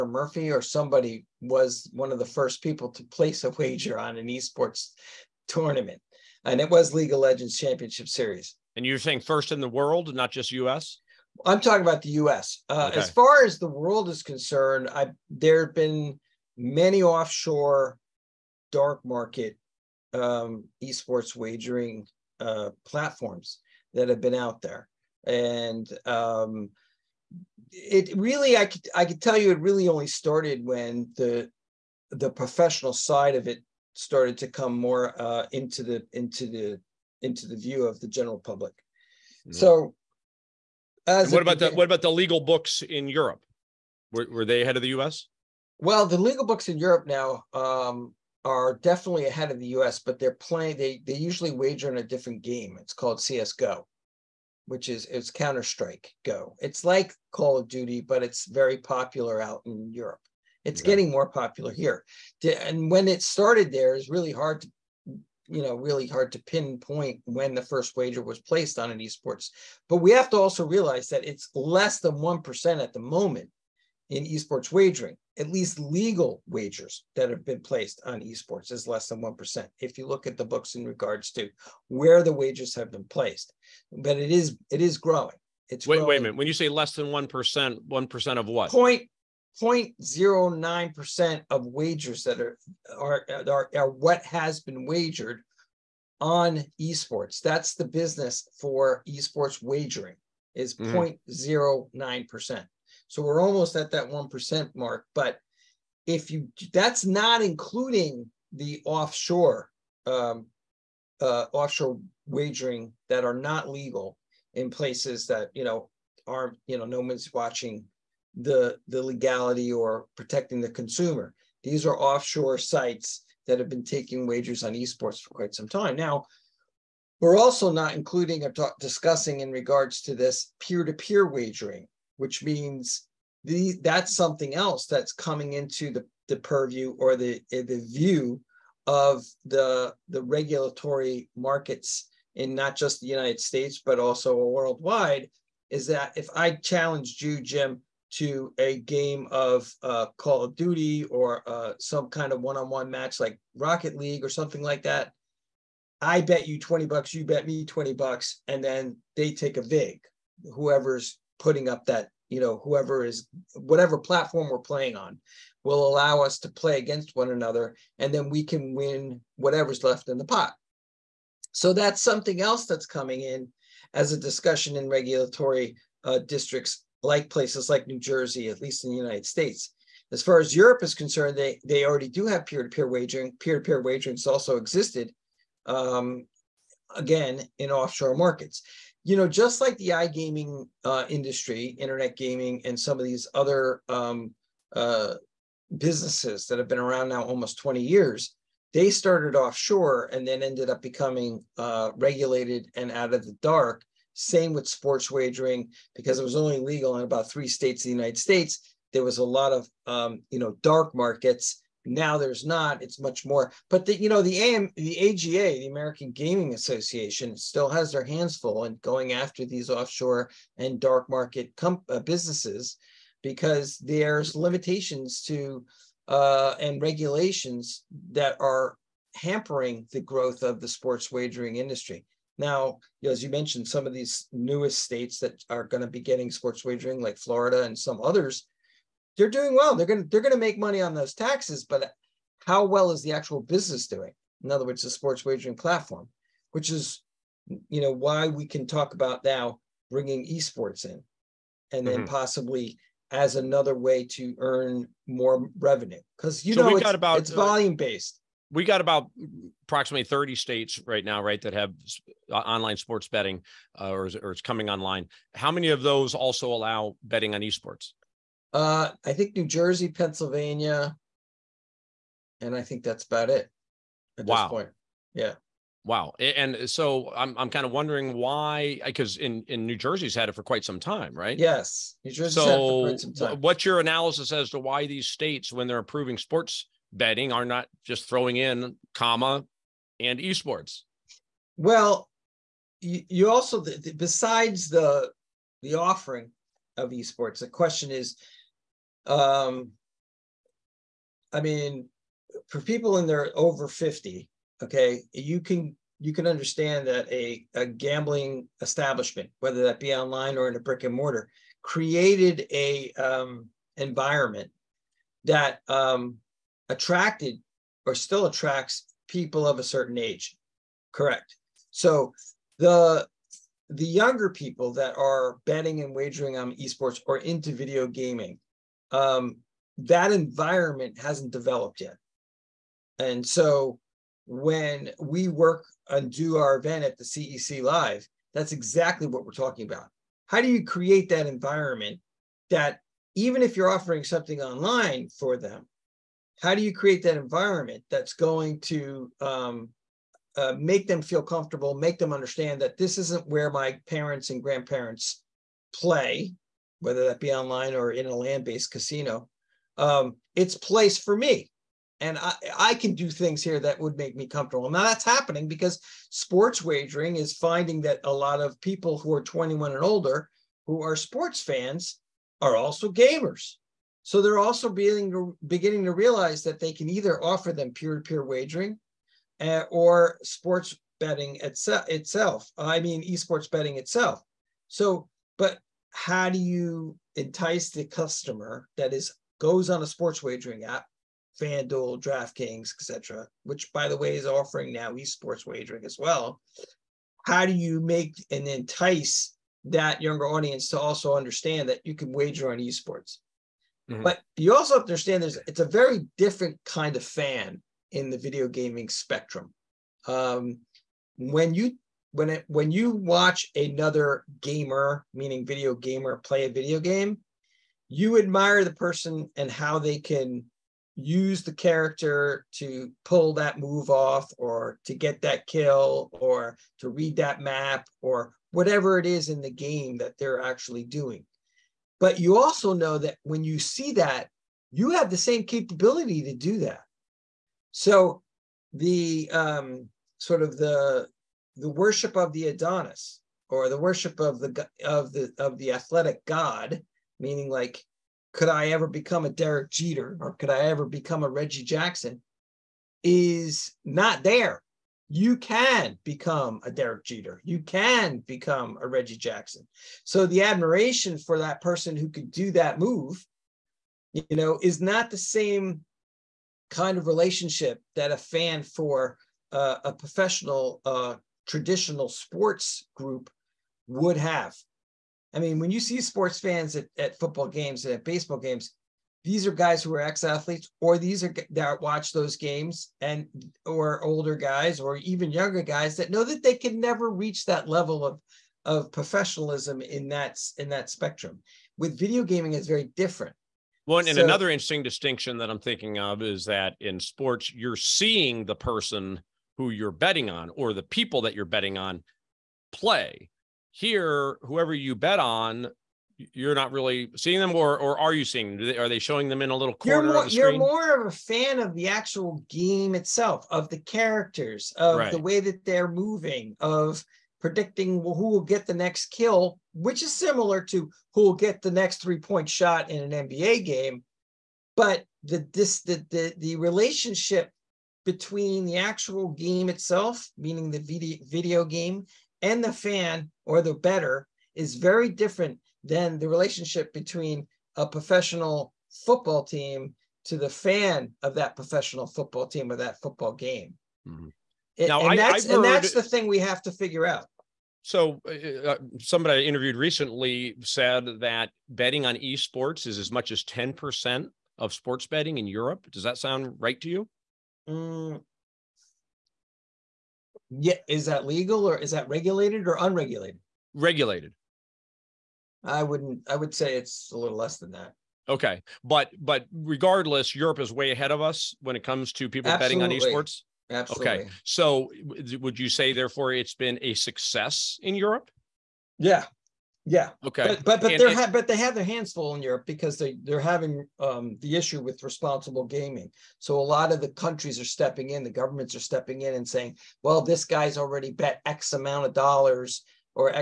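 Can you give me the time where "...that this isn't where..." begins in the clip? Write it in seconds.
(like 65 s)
352 s.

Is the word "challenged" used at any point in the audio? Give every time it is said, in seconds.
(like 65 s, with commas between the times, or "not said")
146 s.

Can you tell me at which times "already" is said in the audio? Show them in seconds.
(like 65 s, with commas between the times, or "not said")
181 s, 590 s.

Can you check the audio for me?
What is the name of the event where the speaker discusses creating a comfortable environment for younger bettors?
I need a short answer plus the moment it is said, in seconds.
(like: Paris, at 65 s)
CEC Live, at 337 s.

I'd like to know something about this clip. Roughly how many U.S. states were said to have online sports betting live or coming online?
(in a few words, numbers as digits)
30.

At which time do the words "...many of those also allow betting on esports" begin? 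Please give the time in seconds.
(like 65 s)
265 s.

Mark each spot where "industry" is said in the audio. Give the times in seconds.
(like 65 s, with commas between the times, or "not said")
191 s, 231 s.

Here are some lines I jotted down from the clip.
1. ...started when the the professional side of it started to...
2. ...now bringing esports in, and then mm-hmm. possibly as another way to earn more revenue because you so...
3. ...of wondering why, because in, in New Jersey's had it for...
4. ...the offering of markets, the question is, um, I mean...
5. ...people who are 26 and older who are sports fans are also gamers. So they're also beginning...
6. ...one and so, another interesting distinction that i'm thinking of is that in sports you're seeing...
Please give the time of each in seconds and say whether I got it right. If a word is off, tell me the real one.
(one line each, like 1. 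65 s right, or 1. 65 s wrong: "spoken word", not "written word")
1. 30 s right
2. 249 s right
3. 277 s right
4. 295 s wrong: "esports", not "markets"
5. 368 s wrong: "21", not "26"
6. 493 s right.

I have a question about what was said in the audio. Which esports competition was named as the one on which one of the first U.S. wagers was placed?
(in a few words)
League of Legends Championship Series.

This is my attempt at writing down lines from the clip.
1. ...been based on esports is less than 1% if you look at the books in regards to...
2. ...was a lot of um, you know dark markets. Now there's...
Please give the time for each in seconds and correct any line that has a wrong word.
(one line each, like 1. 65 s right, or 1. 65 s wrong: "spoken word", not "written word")
1. 77 s wrong: "placed", not "based"
2. 209 s right.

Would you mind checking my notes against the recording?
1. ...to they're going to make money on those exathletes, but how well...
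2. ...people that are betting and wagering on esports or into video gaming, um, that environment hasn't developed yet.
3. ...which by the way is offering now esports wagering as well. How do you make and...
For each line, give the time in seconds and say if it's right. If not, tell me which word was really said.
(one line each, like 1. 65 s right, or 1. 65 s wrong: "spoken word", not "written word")
1. 240 s wrong: "taxes", not "exathletes"
2. 324 s right
3. 393 s right.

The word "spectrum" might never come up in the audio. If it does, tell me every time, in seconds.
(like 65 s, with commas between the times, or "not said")
408 s, 490 s.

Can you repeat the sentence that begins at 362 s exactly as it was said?
And I, I can do things here that would make me comfortable.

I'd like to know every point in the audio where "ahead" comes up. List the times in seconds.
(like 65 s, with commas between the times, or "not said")
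44 s, 49 s, 570 s.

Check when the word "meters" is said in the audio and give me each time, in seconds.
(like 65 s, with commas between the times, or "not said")
not said.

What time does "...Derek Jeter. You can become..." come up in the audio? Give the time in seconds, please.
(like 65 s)
456 s.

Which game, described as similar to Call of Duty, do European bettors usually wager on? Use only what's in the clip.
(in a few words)
CS:GO.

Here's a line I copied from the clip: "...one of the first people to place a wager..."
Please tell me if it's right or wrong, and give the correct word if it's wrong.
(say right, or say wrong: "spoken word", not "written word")
right.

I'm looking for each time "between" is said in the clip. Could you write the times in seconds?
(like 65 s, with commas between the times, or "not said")
528 s, 536 s.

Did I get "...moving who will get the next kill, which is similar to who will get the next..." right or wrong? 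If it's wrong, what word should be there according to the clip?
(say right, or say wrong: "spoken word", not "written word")
wrong: "predicting", not "moving".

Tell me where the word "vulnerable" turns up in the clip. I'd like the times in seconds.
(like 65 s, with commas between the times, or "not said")
not said.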